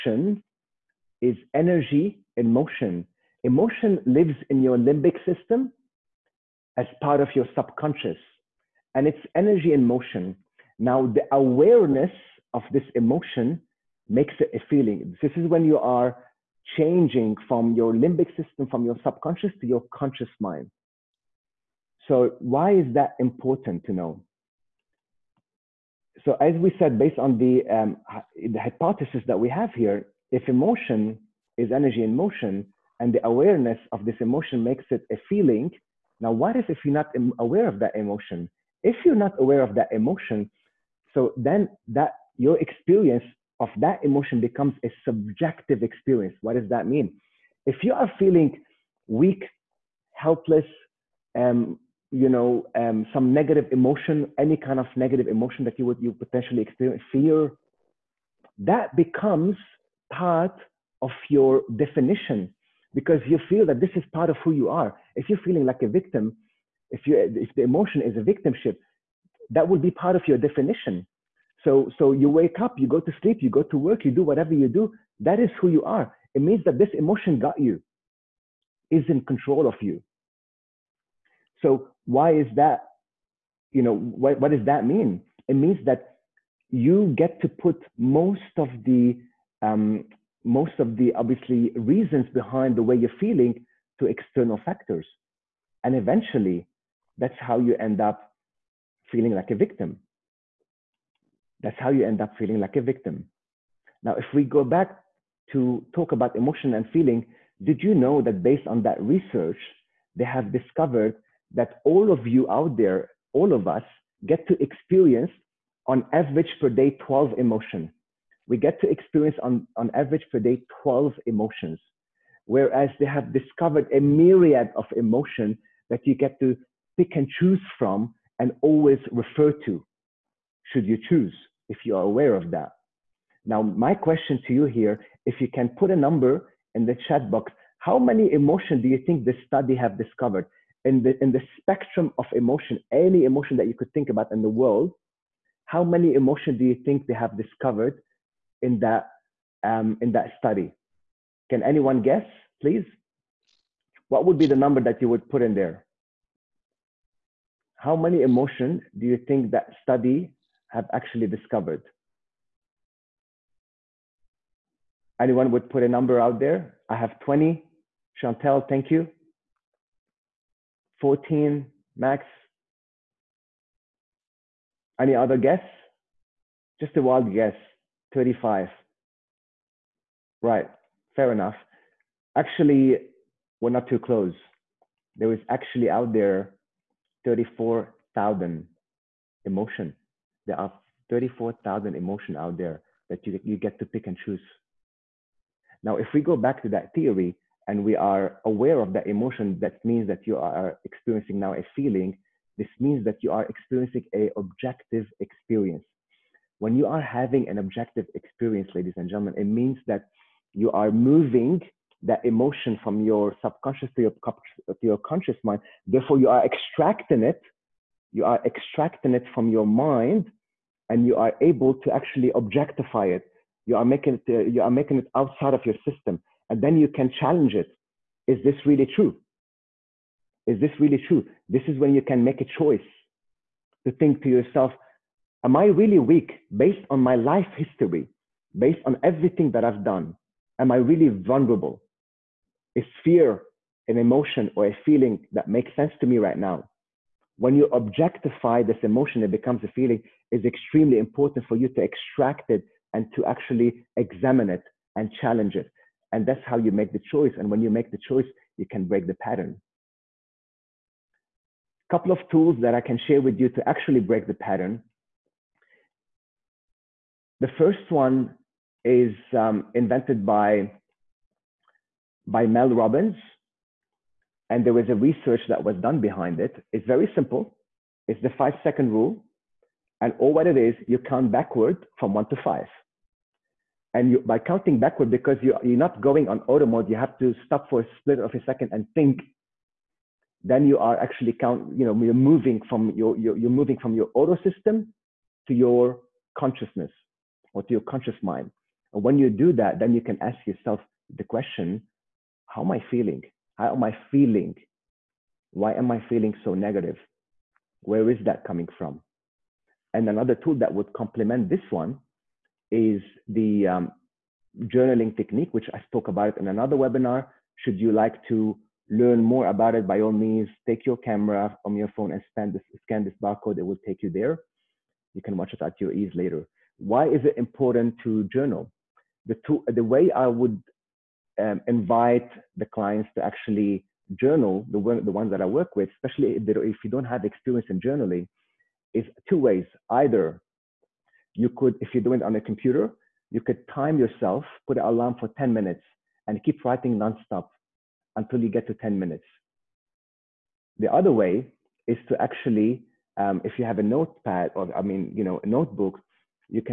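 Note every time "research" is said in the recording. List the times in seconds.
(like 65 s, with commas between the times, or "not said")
109 s, 274 s.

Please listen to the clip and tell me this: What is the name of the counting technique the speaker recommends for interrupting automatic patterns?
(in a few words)
five second rule.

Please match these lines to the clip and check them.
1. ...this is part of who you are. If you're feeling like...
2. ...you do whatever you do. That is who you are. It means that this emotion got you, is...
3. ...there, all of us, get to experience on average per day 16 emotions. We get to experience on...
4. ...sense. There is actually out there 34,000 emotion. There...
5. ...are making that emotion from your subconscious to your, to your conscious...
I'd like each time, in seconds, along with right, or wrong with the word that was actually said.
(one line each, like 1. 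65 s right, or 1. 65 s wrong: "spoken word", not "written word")
1. 63 s right
2. 74 s right
3. 112 s wrong: "12", not "16"
4. 183 s wrong: "close", not "sense"
5. 210 s wrong: "moving", not "making".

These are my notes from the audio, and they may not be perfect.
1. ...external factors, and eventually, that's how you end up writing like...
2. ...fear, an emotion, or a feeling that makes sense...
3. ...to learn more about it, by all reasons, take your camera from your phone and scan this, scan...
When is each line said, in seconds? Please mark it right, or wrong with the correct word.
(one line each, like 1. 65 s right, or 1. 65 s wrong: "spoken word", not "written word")
1. 94 s wrong: "feeling", not "writing"
2. 243 s right
3. 318 s wrong: "means", not "reasons".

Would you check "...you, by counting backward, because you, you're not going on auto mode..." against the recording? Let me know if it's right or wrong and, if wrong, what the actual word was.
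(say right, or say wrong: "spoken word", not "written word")
right.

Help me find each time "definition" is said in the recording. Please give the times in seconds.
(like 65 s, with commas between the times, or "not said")
61 s, 70 s.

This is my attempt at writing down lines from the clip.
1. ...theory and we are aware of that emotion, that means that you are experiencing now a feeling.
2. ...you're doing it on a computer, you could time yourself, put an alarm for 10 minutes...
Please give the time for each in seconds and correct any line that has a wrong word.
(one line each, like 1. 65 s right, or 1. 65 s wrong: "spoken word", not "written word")
1. 196 s right
2. 341 s right.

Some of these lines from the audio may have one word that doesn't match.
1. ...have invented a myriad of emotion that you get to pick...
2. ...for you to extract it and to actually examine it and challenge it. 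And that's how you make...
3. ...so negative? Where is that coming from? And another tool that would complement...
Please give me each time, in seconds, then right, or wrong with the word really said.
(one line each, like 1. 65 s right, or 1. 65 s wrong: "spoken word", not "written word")
1. 123 s wrong: "discovered", not "invented"
2. 251 s right
3. 306 s right.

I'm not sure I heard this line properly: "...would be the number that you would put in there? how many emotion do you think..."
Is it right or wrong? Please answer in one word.
right.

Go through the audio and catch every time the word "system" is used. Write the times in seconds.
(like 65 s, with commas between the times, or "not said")
5 s, 18 s, 225 s, 294 s.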